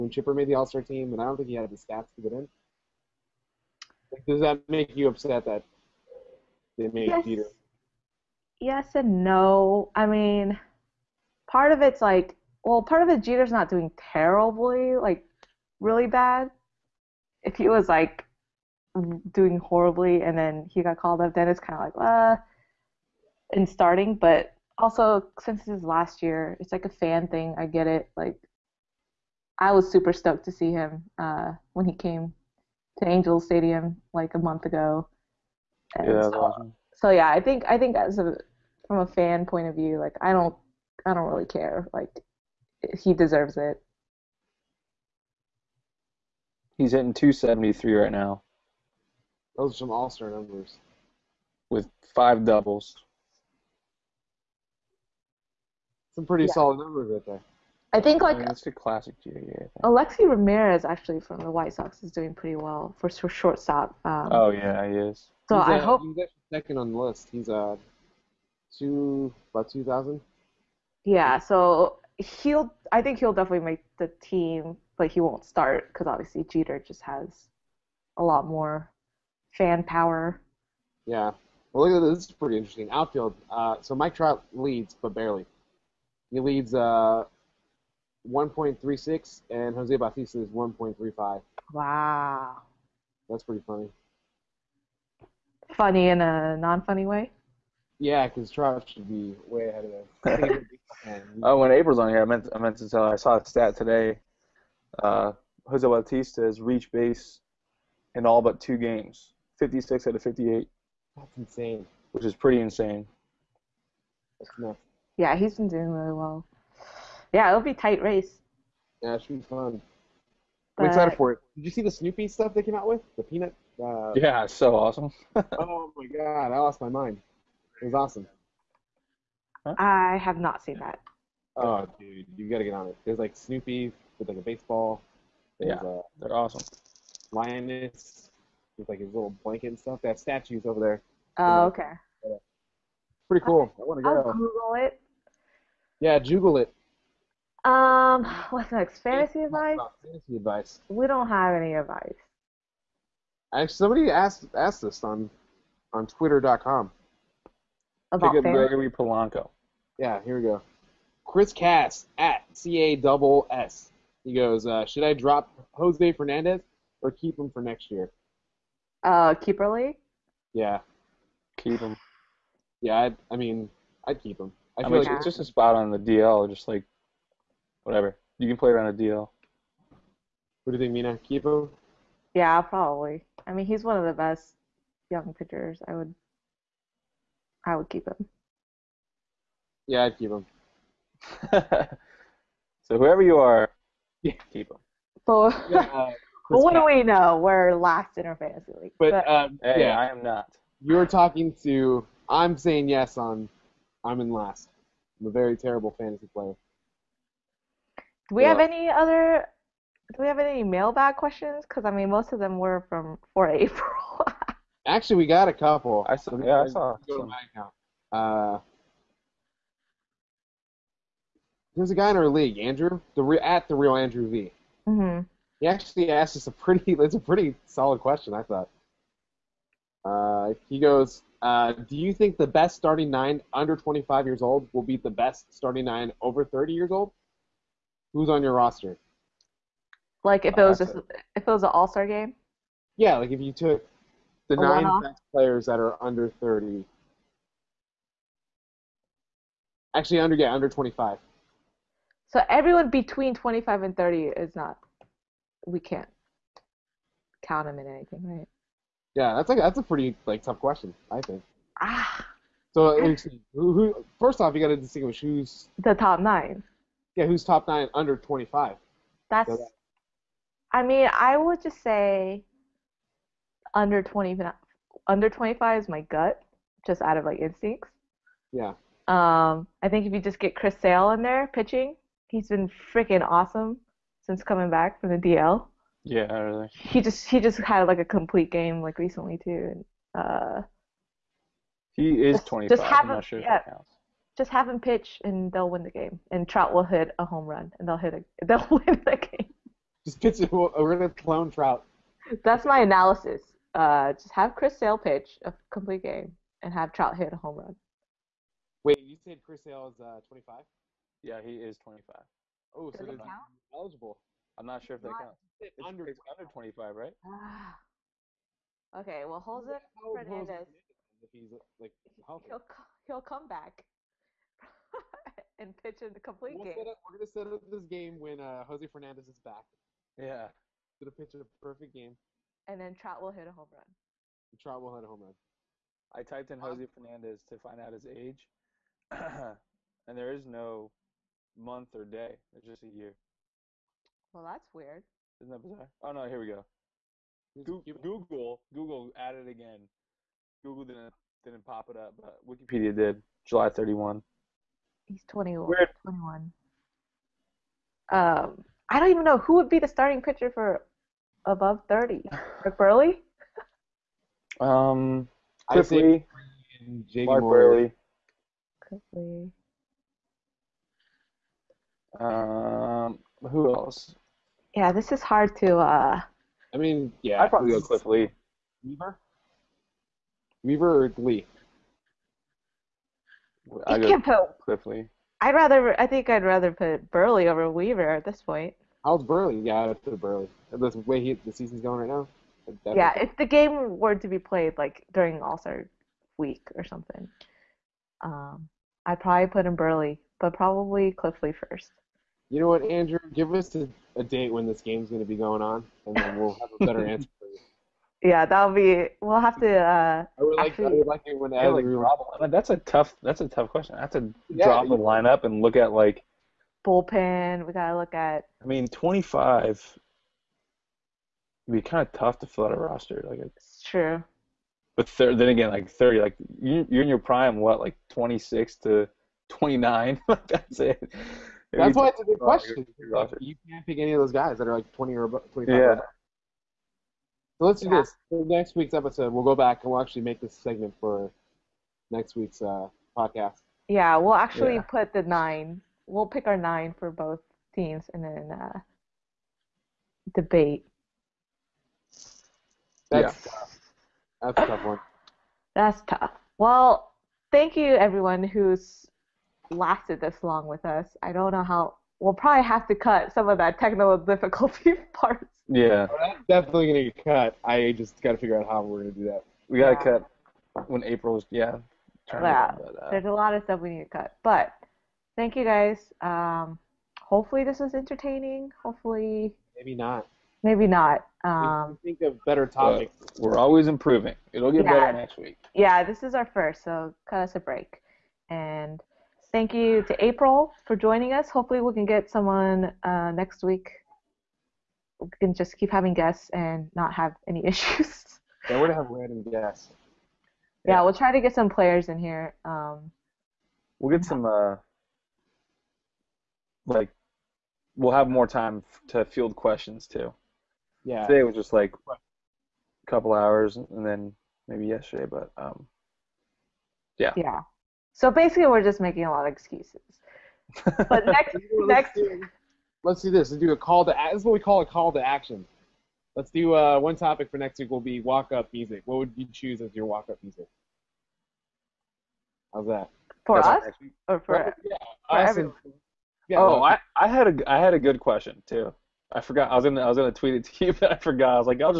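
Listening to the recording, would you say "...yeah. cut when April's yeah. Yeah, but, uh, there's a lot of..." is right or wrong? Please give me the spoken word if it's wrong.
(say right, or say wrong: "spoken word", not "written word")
right.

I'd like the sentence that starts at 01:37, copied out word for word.
Yeah, because Trav should be way ahead of that.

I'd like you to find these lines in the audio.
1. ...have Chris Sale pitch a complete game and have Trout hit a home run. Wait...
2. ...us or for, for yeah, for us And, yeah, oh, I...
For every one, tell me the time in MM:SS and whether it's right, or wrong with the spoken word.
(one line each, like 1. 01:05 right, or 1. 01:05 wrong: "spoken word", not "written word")
1. 05:04 right
2. 08:53 right.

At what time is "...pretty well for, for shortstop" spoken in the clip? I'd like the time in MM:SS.
01:02.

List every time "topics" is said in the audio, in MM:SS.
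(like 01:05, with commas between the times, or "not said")
08:02, 08:47.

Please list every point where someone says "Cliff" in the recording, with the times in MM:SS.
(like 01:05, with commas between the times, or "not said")
06:05, 06:17, 06:24, 06:41.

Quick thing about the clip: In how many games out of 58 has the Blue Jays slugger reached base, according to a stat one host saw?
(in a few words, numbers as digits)
56.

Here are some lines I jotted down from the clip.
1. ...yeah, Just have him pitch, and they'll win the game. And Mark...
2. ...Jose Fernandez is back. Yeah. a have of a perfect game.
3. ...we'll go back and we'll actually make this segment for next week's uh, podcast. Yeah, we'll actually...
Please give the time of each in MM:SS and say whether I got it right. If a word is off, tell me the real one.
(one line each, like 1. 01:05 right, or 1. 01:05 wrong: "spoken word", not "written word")
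1. 04:53 wrong: "Trout", not "Mark"
2. 05:28 right
3. 07:19 right.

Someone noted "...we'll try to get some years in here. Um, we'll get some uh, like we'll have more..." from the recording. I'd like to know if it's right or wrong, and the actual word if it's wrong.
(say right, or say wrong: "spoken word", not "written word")
wrong: "players", not "years".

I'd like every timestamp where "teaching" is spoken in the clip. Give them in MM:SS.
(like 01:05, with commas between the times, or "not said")
not said.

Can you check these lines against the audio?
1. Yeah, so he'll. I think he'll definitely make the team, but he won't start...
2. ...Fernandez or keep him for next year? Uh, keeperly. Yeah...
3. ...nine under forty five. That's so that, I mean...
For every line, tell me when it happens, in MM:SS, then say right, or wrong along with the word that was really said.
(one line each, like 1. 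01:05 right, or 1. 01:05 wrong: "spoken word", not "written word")
1. 01:11 right
2. 02:46 right
3. 04:27 wrong: "twenty", not "forty".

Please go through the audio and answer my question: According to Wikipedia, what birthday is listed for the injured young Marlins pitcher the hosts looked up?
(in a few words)
July 31.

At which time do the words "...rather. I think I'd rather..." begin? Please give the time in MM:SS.
06:25.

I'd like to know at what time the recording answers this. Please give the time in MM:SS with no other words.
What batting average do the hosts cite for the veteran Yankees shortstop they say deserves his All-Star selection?
00:47.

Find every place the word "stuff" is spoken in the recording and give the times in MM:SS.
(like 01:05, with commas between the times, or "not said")
02:02, 02:19, 07:53.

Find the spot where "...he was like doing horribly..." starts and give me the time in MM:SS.
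00:17.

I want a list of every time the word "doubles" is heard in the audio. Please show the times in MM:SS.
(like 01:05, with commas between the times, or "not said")
00:52, 02:42.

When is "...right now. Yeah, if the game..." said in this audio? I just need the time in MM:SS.
06:32.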